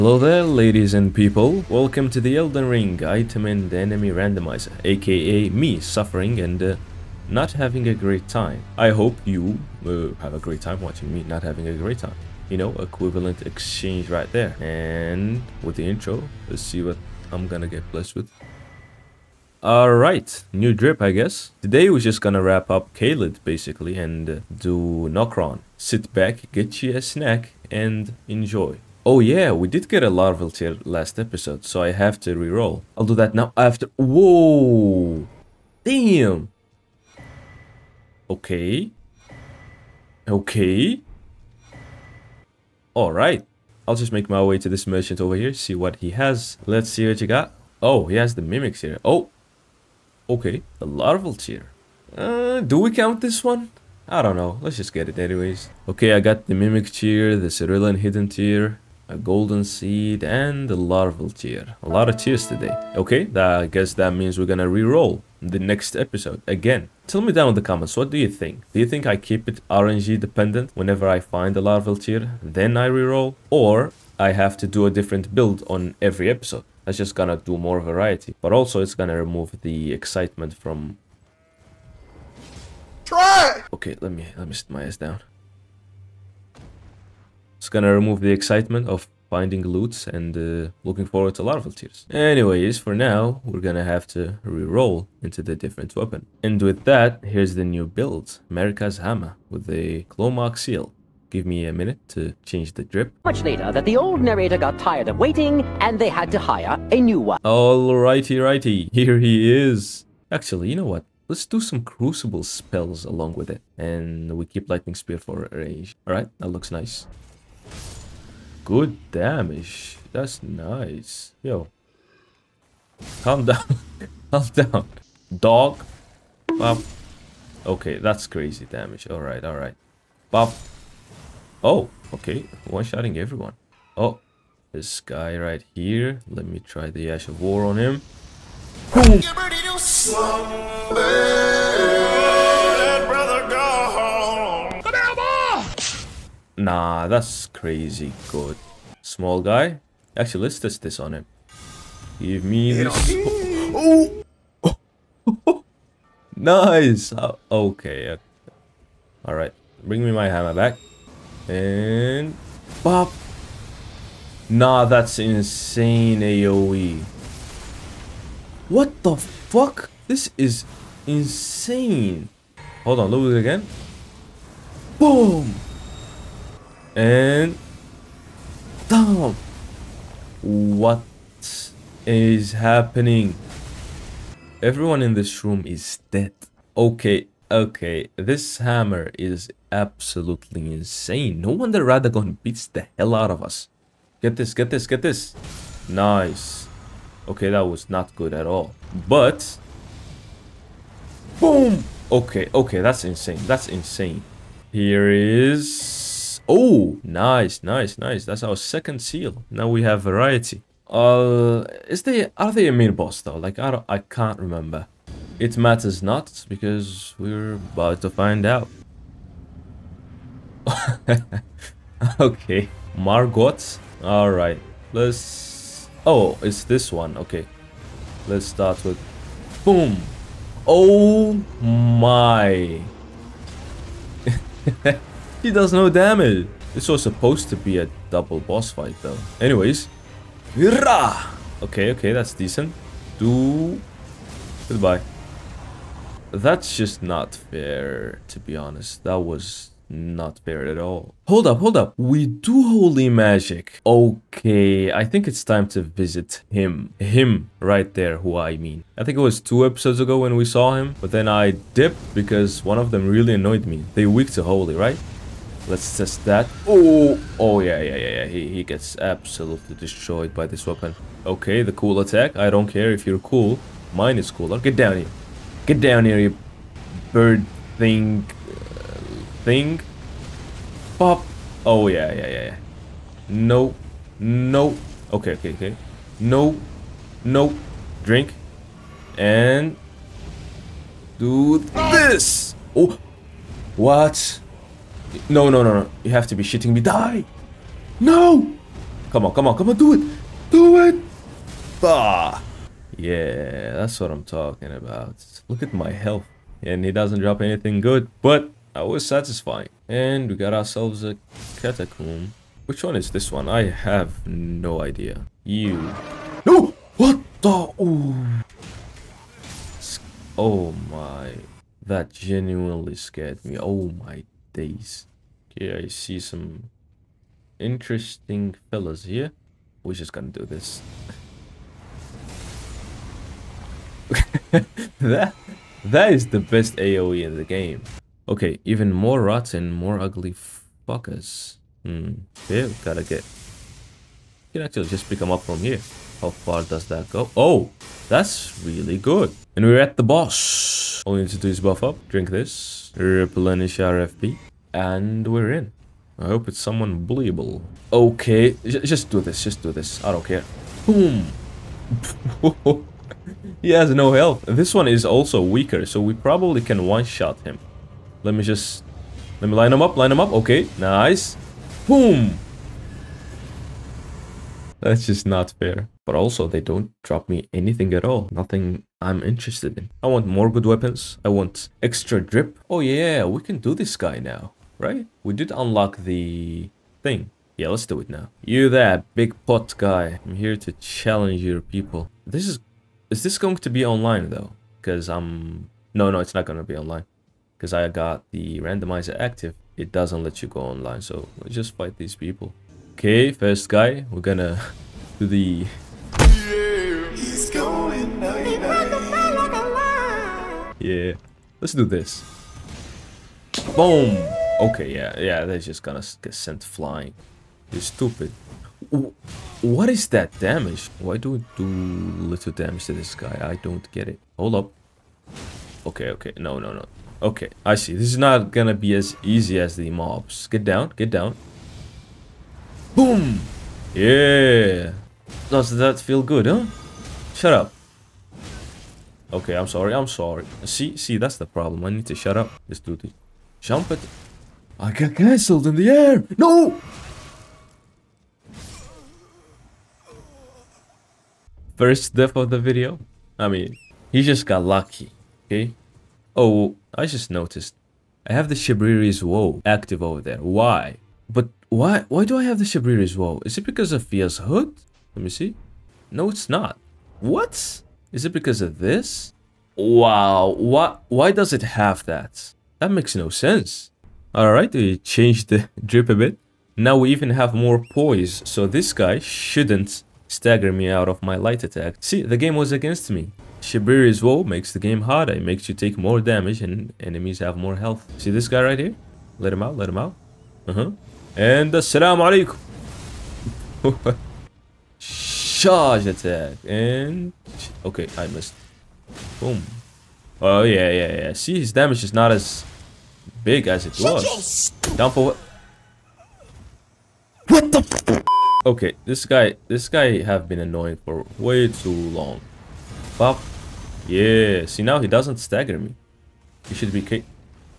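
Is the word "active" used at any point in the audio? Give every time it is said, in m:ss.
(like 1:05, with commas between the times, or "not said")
6:39, 7:39.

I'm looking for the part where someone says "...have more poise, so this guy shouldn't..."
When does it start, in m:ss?
7:57.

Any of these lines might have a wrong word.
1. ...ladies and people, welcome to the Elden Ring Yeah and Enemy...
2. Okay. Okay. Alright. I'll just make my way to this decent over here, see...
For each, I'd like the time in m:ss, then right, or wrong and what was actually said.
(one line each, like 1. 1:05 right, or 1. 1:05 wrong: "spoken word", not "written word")
1. 0:00 wrong: "Item", not "Yeah"
2. 0:38 wrong: "merchant", not "decent".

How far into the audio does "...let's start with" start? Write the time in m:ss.
3:48.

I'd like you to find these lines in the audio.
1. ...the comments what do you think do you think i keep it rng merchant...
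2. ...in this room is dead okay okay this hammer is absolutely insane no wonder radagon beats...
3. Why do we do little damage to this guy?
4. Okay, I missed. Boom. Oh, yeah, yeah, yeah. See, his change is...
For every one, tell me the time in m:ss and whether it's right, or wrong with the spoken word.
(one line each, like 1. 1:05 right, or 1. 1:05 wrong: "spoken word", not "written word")
1. 1:07 wrong: "dependent", not "merchant"
2. 3:05 right
3. 7:00 right
4. 8:17 wrong: "damage", not "change".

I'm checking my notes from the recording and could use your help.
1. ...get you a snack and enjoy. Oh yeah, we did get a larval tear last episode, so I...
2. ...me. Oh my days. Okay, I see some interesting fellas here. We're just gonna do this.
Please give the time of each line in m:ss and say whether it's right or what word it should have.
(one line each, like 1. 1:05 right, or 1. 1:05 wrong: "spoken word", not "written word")
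1. 0:26 right
2. 5:23 right.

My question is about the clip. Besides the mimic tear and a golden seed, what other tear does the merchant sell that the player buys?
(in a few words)
Cerulean hidden tear.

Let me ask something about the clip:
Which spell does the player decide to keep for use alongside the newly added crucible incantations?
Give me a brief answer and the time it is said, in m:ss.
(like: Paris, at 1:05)
Lightning spear, at 1:54.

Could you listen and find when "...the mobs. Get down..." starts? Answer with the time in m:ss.
7:09.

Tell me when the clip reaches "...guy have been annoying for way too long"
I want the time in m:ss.
8:29.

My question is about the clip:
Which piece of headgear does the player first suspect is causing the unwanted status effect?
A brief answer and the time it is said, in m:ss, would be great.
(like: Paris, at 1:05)
Fia's hood, at 7:44.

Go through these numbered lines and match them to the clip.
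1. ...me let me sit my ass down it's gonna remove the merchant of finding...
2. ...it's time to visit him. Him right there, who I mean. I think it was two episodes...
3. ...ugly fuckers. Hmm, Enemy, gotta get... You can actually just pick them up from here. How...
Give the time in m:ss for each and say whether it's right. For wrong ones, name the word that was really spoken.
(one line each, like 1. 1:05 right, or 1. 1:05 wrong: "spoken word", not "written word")
1. 1:24 wrong: "excitement", not "merchant"
2. 4:15 right
3. 5:39 wrong: "Yeah", not "Enemy".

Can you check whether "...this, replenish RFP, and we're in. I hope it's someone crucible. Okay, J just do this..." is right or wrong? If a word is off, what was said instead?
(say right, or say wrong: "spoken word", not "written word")
wrong: "bullyable", not "crucible".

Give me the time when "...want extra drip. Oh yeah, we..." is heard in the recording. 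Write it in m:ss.
6:21.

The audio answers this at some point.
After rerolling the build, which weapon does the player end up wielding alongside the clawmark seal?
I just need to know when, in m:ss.
1:38.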